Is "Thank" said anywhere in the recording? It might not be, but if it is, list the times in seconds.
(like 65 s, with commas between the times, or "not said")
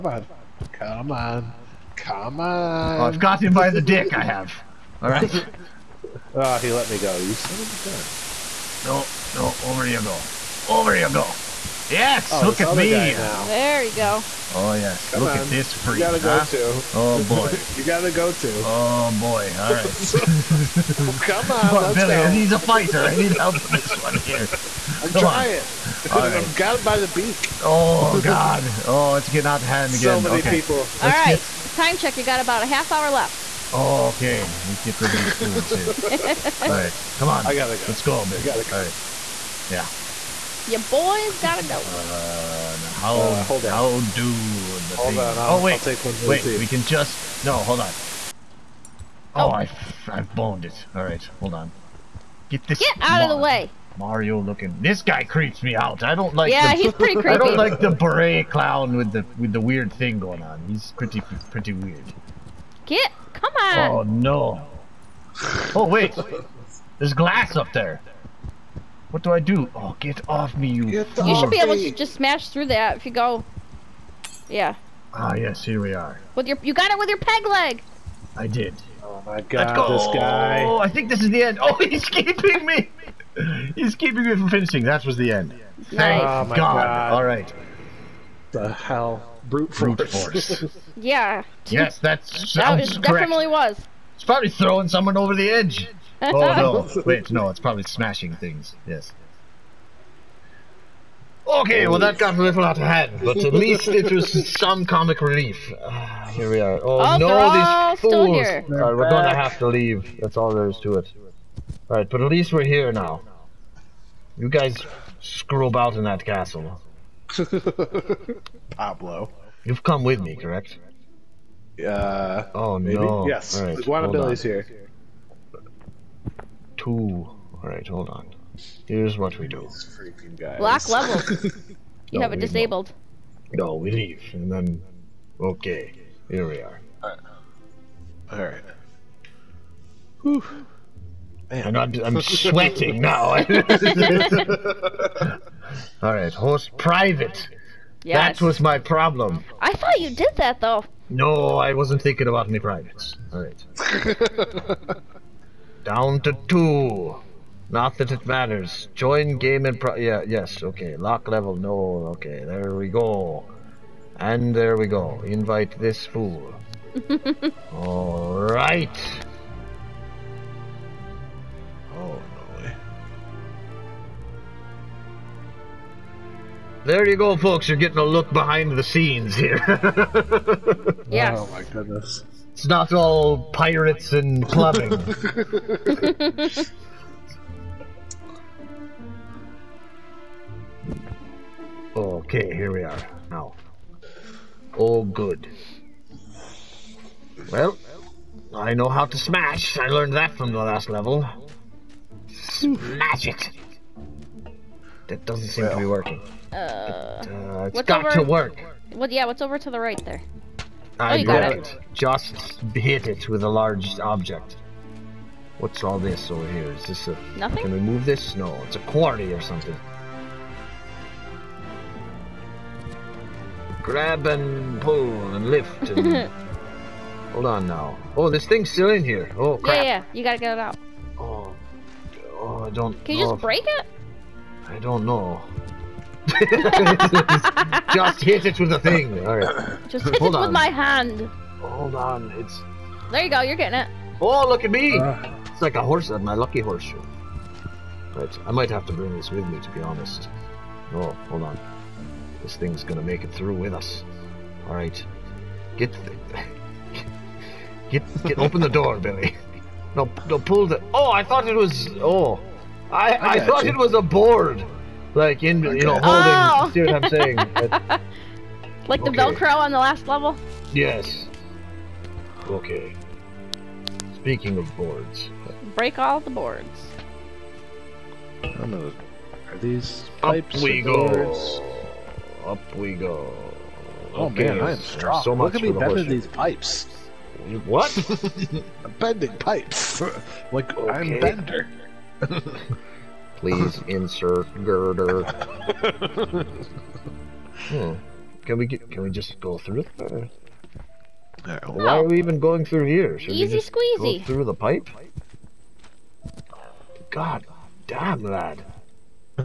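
85 s.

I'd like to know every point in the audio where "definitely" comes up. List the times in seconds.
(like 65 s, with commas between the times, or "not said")
93 s.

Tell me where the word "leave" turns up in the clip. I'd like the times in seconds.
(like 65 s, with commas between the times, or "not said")
109 s, 133 s.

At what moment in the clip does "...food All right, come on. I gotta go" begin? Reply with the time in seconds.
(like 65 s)
35 s.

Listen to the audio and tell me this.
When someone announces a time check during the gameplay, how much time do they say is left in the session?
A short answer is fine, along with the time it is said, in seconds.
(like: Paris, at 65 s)
half hour, at 32 s.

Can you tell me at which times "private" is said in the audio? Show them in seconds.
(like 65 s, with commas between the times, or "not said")
146 s, 152 s.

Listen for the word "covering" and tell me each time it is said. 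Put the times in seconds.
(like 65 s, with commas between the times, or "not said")
not said.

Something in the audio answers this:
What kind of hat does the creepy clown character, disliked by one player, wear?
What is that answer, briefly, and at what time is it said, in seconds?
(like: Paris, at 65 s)
beret, at 57 s.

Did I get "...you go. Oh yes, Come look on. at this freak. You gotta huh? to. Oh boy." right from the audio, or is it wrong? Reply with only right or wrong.
right.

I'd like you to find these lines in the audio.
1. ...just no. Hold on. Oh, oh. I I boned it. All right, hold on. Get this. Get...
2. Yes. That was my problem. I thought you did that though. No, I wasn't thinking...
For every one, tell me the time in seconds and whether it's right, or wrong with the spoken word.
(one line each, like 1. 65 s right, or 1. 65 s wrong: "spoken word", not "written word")
1. 46 s right
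2. 148 s right.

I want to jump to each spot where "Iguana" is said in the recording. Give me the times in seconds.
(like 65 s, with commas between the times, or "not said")
123 s.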